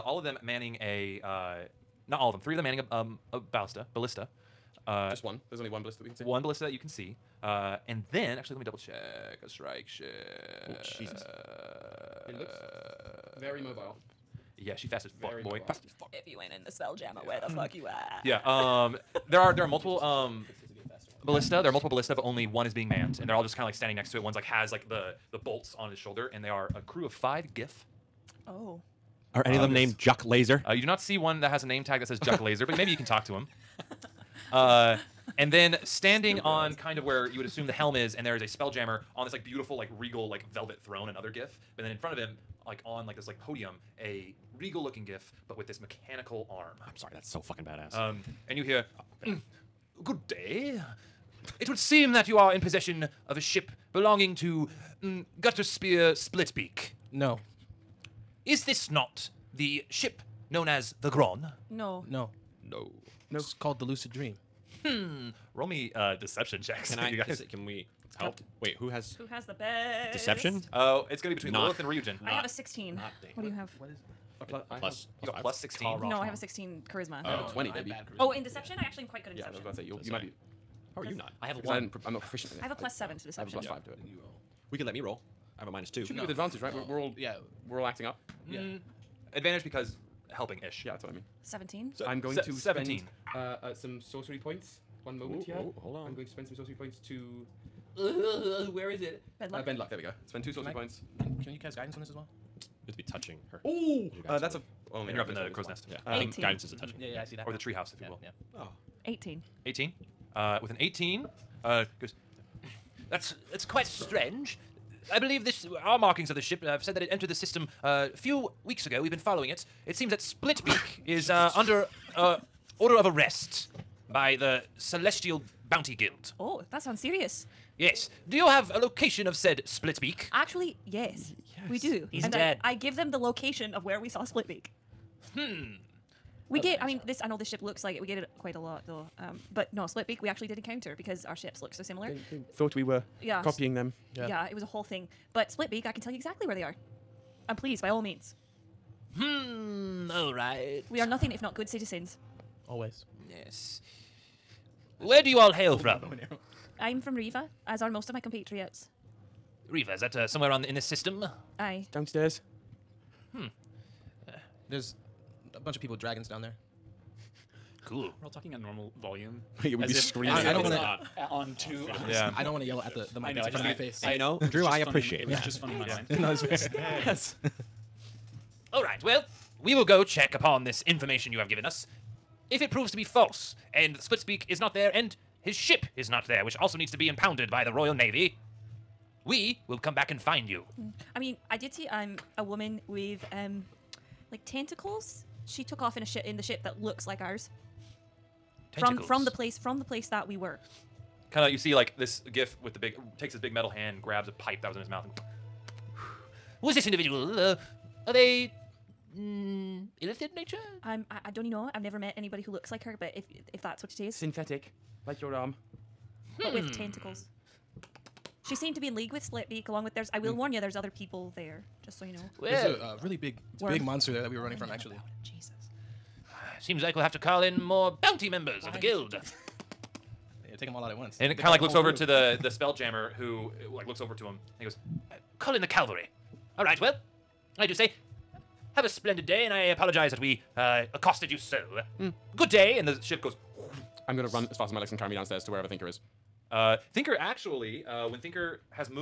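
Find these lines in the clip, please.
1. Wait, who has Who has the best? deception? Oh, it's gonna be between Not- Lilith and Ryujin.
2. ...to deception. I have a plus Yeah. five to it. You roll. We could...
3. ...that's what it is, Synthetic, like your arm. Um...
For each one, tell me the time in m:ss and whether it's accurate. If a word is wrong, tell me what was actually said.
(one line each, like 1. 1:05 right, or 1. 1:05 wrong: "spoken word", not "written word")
1. 1:08 right
2. 1:23 right
3. 3:33 right.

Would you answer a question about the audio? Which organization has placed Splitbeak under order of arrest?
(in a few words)
Celestial Bounty Guild.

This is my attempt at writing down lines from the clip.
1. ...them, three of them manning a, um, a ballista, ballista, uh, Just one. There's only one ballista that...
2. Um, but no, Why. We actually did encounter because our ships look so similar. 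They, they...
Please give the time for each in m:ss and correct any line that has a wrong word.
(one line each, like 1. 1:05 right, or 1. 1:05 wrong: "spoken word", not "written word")
1. 0:02 right
2. 2:19 wrong: "Splitbeak", not "Why".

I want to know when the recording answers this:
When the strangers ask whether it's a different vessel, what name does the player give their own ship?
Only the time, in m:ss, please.
1:03.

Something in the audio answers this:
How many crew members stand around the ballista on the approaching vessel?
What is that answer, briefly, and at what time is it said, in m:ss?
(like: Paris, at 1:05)
5, at 0:26.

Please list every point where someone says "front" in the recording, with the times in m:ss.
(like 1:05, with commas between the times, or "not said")
0:41, 2:53.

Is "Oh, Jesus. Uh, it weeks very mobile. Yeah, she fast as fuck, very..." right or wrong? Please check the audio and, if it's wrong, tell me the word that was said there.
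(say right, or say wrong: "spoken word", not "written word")
wrong: "looks", not "weeks".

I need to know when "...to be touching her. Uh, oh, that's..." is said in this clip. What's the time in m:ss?
1:42.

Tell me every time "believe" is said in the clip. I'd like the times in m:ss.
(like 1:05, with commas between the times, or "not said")
1:55.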